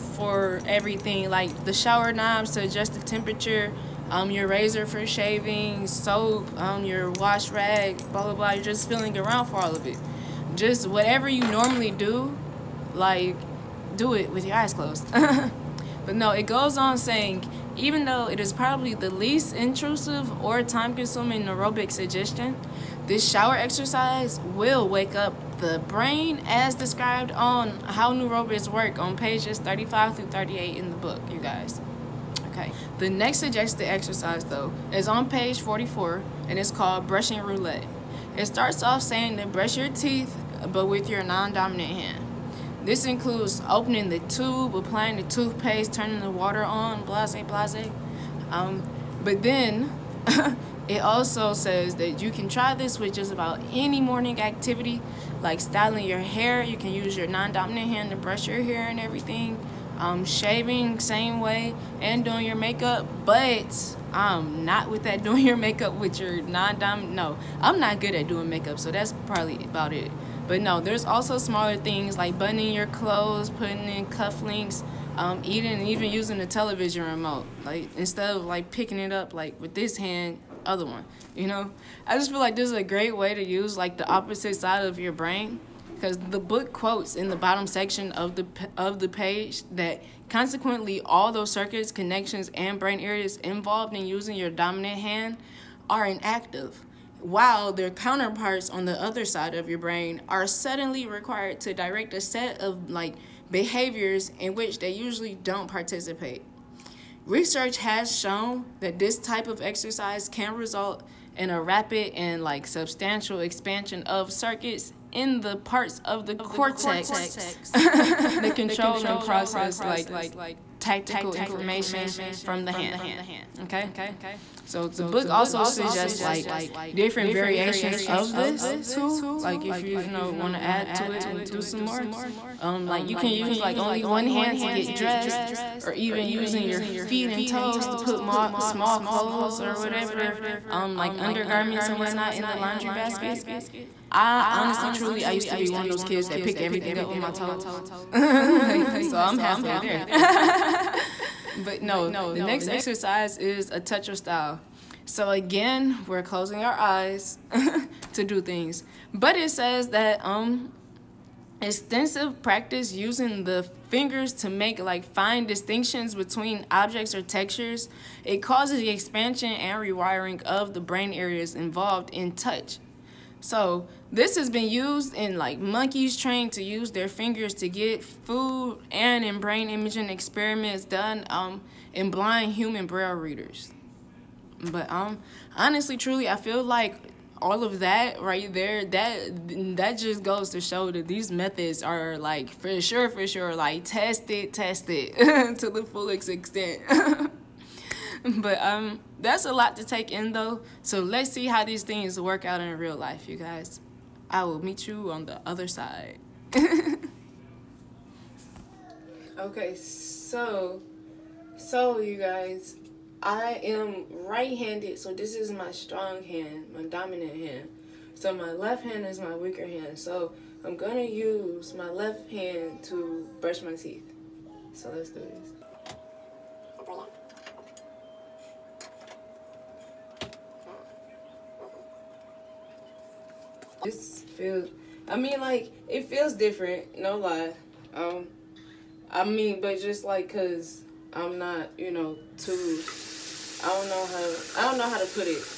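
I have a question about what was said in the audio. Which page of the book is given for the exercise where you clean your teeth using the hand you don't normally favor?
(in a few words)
44.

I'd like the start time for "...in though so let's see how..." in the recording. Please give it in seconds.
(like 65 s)
200 s.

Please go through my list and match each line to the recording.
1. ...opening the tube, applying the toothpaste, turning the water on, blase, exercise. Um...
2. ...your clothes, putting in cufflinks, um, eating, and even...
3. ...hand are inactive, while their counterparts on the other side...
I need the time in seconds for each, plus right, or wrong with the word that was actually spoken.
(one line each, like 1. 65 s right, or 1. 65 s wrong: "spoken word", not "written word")
1. 43 s wrong: "blase", not "exercise"
2. 72 s right
3. 95 s right.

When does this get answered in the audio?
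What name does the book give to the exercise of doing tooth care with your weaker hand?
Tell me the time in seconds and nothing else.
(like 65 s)
37 s.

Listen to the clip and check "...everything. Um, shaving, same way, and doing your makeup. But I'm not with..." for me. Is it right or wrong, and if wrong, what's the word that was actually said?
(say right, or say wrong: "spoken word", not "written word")
right.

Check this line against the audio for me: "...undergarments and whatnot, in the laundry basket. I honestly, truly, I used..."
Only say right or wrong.
right.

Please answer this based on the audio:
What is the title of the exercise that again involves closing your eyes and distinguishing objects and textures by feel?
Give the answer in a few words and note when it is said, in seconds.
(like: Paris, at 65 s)
A touch of style, at 153 s.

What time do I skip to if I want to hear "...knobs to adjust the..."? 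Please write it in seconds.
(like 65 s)
2 s.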